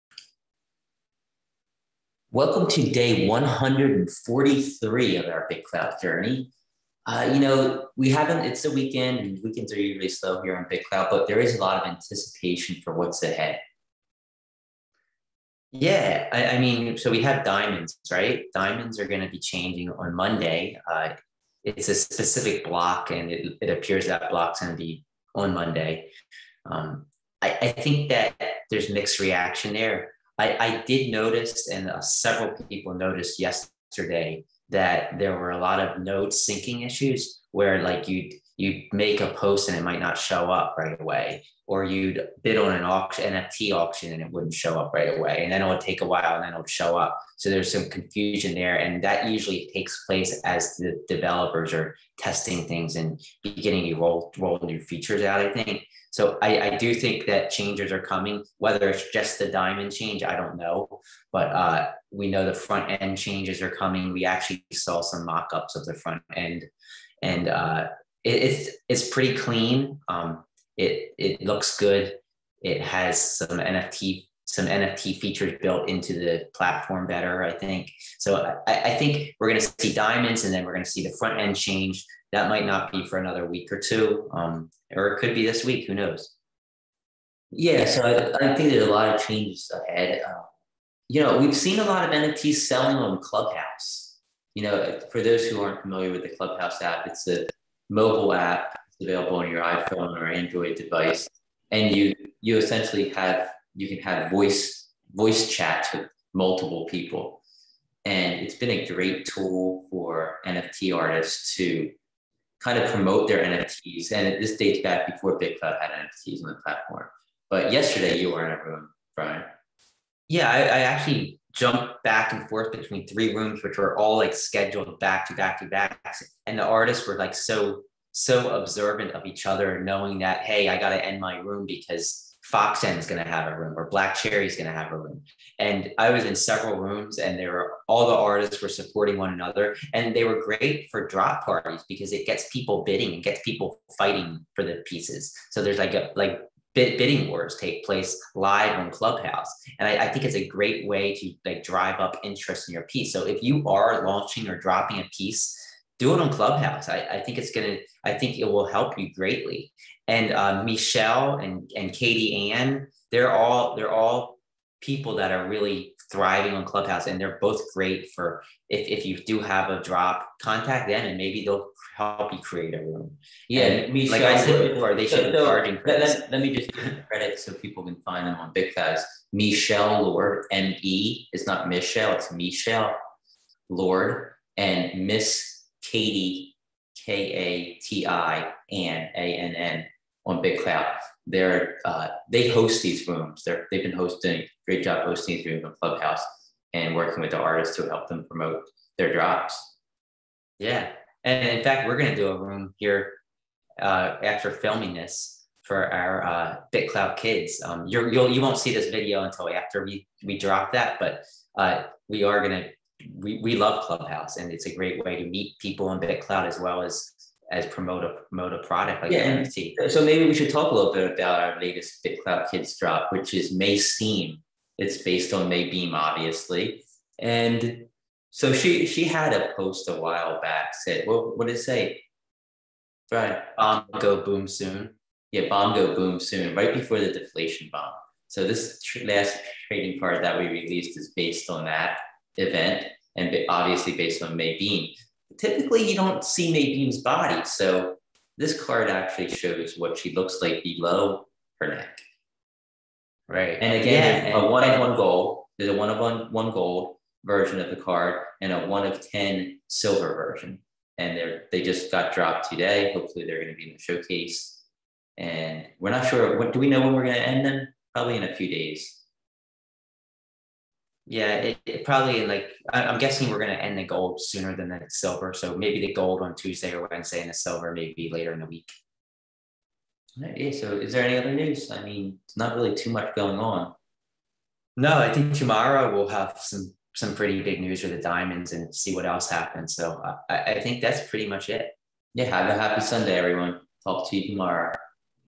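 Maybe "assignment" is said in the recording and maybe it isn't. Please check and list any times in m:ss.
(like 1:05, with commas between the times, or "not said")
not said.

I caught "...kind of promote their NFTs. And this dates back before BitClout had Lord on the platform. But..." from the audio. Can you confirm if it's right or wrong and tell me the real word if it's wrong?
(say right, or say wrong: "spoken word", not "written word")
wrong: "NFTs", not "Lord".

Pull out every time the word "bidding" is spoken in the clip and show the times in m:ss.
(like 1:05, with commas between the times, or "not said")
2:22, 2:26.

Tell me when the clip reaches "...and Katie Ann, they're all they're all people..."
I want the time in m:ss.
2:41.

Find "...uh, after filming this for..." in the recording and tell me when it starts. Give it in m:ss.
3:23.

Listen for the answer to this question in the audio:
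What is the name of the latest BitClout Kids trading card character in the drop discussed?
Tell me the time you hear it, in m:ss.
3:43.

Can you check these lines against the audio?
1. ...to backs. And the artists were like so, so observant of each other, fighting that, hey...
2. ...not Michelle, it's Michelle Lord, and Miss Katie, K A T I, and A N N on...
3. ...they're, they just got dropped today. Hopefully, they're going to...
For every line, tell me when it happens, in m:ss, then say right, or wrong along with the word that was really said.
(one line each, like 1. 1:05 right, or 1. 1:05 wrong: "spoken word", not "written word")
1. 2:05 wrong: "knowing", not "fighting"
2. 3:01 right
3. 4:21 right.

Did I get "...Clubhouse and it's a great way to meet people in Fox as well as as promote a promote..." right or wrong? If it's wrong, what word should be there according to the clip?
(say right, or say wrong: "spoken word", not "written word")
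wrong: "BitClout", not "Fox".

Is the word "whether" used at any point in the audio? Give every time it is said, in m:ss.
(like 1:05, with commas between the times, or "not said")
0:58.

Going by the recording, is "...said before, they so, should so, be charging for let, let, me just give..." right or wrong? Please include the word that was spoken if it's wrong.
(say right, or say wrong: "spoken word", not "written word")
right.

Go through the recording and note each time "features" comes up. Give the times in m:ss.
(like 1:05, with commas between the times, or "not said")
0:54, 1:15.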